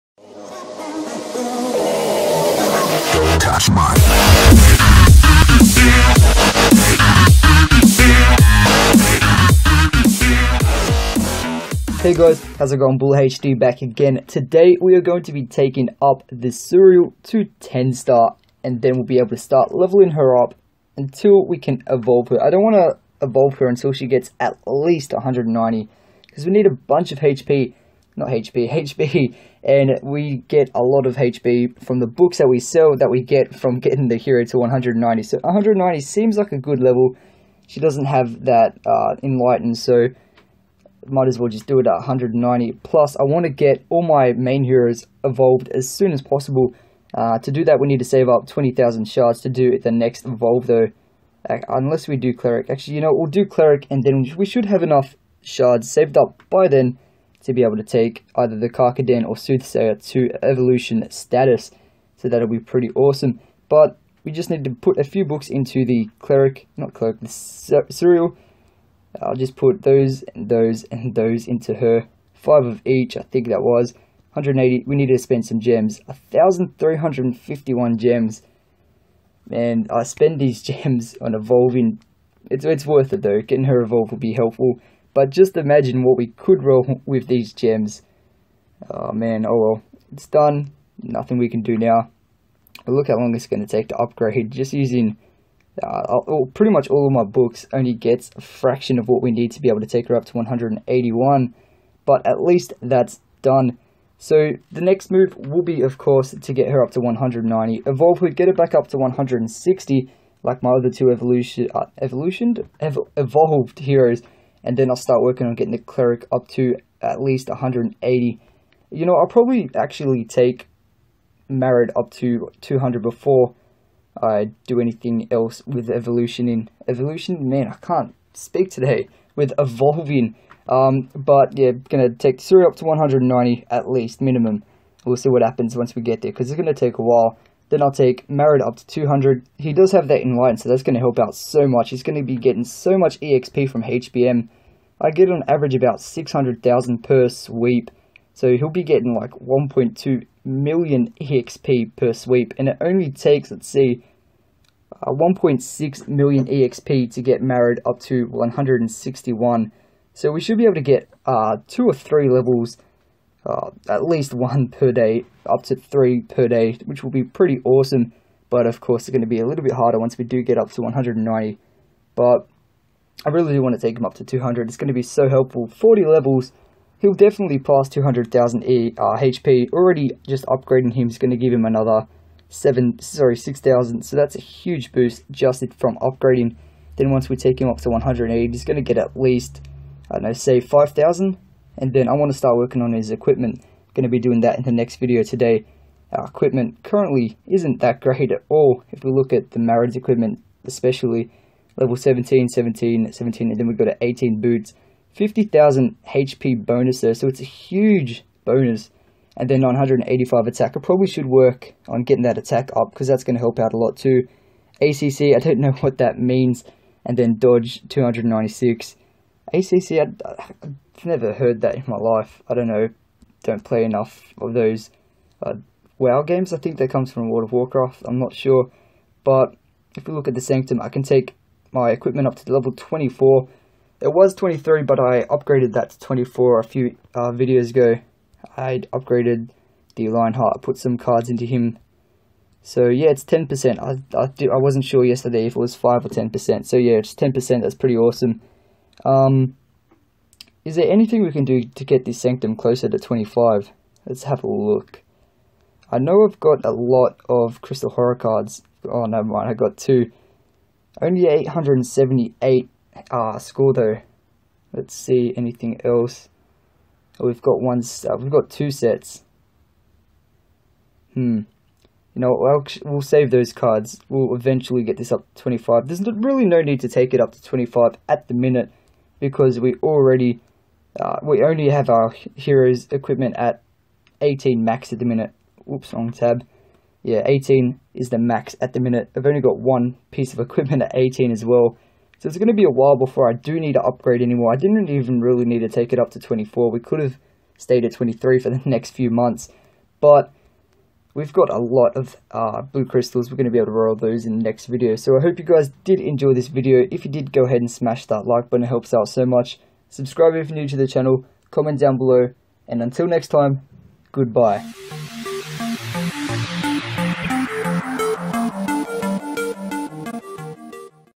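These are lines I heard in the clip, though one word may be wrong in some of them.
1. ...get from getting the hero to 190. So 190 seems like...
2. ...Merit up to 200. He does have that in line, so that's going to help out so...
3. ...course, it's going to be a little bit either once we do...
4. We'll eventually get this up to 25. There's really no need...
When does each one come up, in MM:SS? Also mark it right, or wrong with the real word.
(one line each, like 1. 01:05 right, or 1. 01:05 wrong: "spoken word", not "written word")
1. 00:33 right
2. 02:18 right
3. 02:48 wrong: "harder", not "either"
4. 04:34 right.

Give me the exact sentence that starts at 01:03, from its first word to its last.
But we just need to put a few books into the cleric, not cleric, the Suriel.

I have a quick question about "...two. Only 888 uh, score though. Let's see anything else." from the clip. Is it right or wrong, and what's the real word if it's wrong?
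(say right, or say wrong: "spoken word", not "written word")
wrong: "878", not "888".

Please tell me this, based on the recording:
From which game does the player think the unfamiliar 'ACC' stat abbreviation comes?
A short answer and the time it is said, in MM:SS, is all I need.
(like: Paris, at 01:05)
World of Warcraft, at 03:47.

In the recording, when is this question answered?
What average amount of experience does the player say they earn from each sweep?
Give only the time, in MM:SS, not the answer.
02:26.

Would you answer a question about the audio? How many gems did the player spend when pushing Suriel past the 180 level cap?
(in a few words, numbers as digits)
1,351.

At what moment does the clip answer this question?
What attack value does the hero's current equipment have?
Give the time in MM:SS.
03:29.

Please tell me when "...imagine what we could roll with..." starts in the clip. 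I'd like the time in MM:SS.
01:25.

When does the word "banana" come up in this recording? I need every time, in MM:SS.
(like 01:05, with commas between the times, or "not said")
not said.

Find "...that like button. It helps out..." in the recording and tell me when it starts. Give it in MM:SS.
05:08.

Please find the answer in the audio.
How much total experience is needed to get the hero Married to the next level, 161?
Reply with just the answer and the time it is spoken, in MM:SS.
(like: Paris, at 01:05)
1.6 million, at 02:35.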